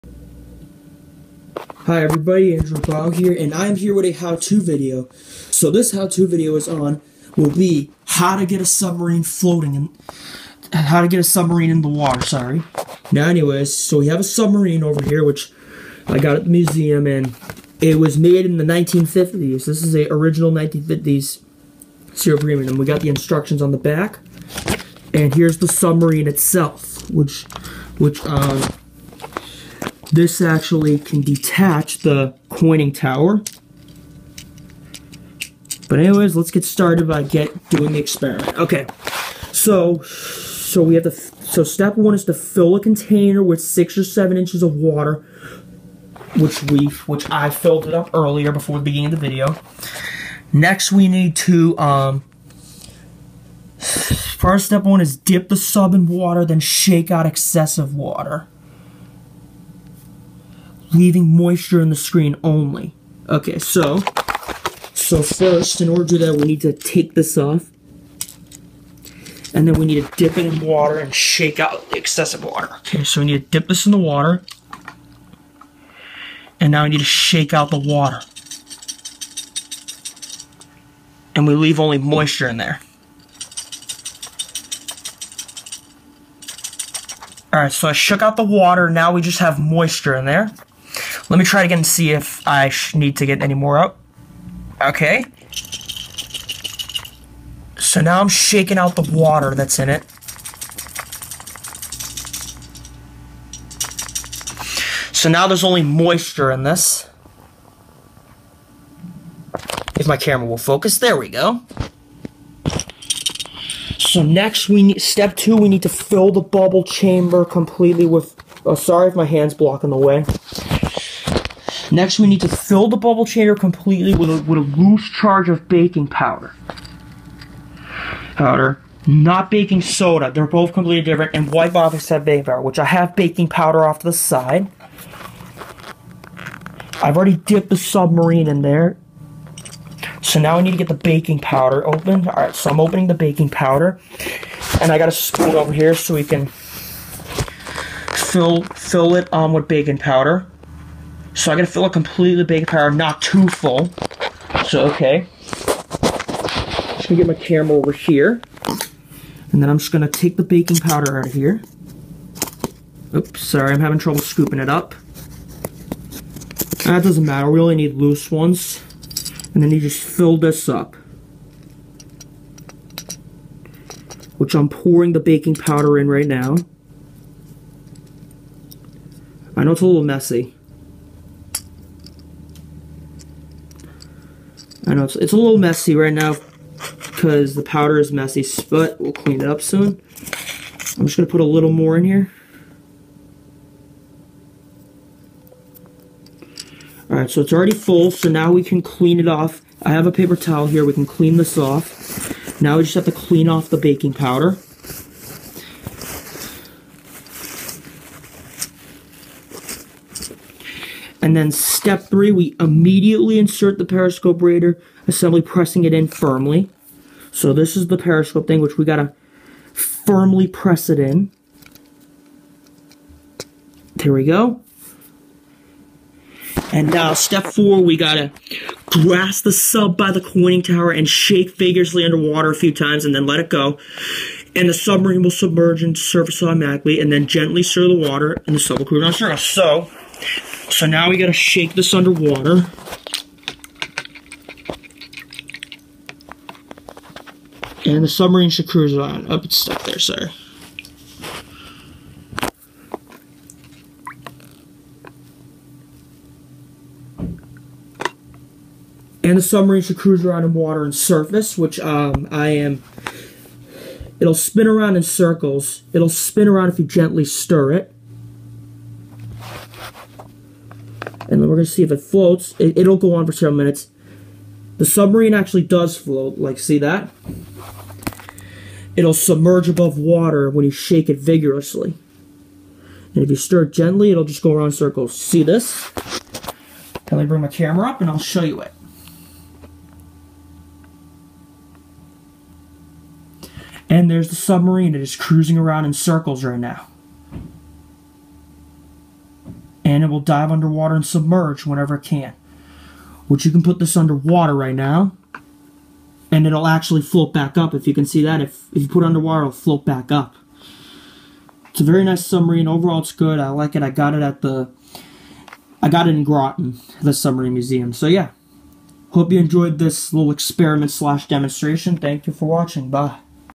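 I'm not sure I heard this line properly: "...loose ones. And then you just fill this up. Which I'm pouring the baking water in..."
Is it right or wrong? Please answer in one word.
wrong.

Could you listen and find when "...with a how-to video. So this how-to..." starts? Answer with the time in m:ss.
0:03.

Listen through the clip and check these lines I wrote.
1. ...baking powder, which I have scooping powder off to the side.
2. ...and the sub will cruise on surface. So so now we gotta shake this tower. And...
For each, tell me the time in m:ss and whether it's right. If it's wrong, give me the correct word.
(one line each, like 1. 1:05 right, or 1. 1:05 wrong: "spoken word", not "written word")
1. 2:12 wrong: "baking", not "scooping"
2. 3:58 wrong: "underwater", not "tower".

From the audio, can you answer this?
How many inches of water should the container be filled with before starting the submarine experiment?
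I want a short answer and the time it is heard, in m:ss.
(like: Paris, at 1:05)
6 or 7 inches, at 0:43.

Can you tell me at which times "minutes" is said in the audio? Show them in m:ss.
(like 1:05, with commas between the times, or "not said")
4:33.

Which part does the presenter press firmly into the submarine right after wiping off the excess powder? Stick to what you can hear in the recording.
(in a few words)
Periscope reader assembly.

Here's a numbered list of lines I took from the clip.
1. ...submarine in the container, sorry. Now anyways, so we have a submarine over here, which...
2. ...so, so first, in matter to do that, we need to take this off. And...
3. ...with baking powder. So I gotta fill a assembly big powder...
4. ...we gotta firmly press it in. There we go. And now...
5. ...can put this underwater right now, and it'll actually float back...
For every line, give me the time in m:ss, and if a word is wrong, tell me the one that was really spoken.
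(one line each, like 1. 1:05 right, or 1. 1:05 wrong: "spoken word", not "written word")
1. 0:11 wrong: "water", not "container"
2. 1:03 wrong: "order", not "matter"
3. 2:29 wrong: "completely", not "assembly"
4. 3:38 right
5. 5:03 right.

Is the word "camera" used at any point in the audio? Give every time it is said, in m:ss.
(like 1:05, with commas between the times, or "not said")
1:50, 2:37, 4:47.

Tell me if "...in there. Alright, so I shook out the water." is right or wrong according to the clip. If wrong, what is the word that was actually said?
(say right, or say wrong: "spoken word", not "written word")
right.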